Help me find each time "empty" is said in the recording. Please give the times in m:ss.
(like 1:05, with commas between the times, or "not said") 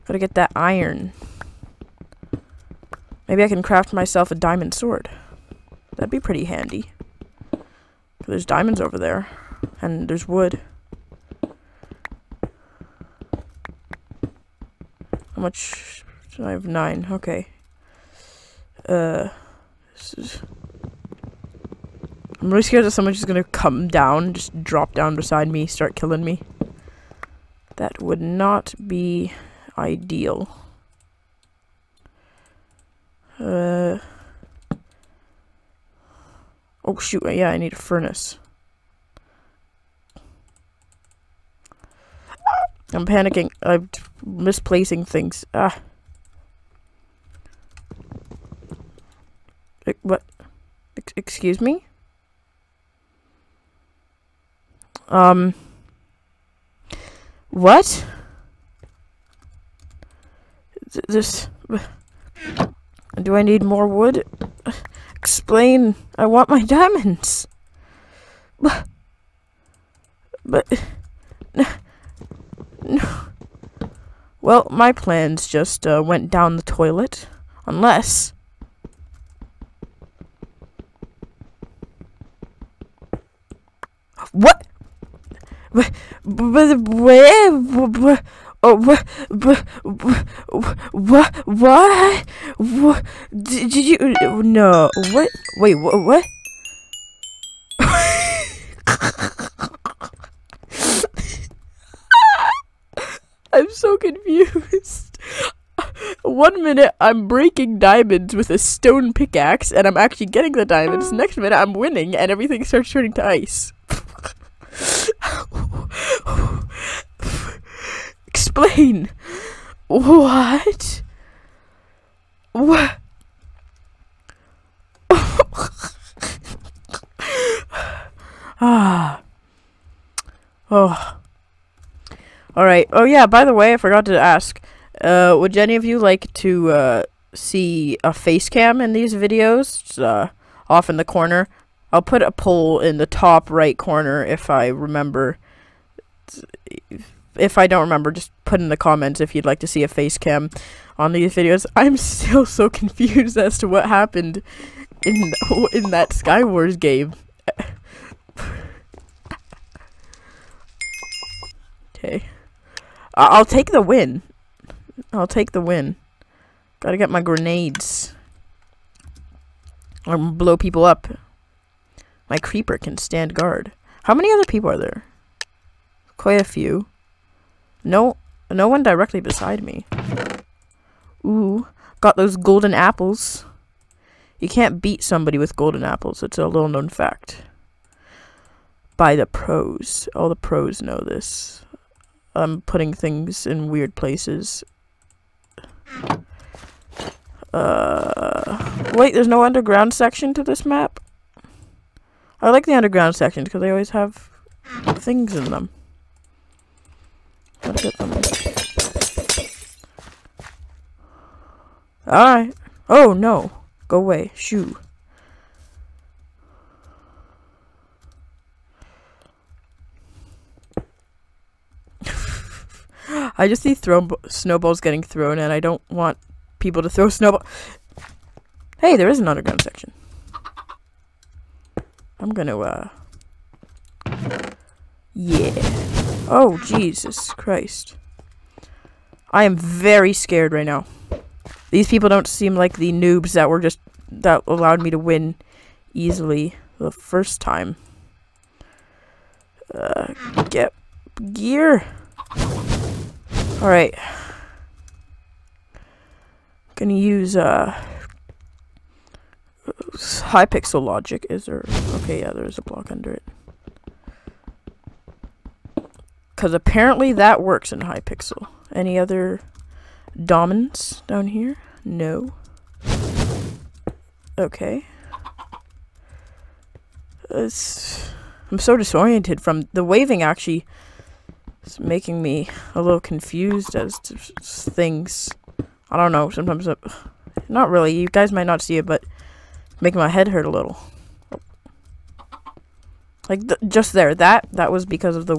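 not said.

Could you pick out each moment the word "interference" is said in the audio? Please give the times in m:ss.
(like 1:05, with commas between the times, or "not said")
not said.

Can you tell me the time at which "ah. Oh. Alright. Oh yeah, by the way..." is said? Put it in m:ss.
2:08.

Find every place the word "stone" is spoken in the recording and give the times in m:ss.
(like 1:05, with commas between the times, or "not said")
1:48.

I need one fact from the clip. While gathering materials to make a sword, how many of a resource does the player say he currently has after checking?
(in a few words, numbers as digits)
9.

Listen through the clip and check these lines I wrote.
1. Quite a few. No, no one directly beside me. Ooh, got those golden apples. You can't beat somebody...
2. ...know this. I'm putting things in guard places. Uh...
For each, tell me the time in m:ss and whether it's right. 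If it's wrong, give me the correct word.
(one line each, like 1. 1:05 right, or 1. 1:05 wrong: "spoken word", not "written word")
1. 2:56 right
2. 3:10 wrong: "weird", not "guard".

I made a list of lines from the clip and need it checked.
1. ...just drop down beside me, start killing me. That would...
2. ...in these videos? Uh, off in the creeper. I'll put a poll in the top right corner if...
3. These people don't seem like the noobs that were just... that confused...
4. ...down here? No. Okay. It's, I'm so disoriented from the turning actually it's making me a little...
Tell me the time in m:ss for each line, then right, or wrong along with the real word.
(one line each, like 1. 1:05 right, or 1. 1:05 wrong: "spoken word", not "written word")
1. 0:24 right
2. 2:18 wrong: "corner", not "creeper"
3. 4:01 wrong: "allowed", not "confused"
4. 4:31 wrong: "waving", not "turning".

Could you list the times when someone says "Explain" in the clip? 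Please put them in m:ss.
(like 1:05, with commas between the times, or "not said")
1:05, 1:58.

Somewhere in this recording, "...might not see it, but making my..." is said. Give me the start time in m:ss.
4:48.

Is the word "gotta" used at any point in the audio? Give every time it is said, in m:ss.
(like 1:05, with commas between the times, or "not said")
0:00, 2:46, 3:27.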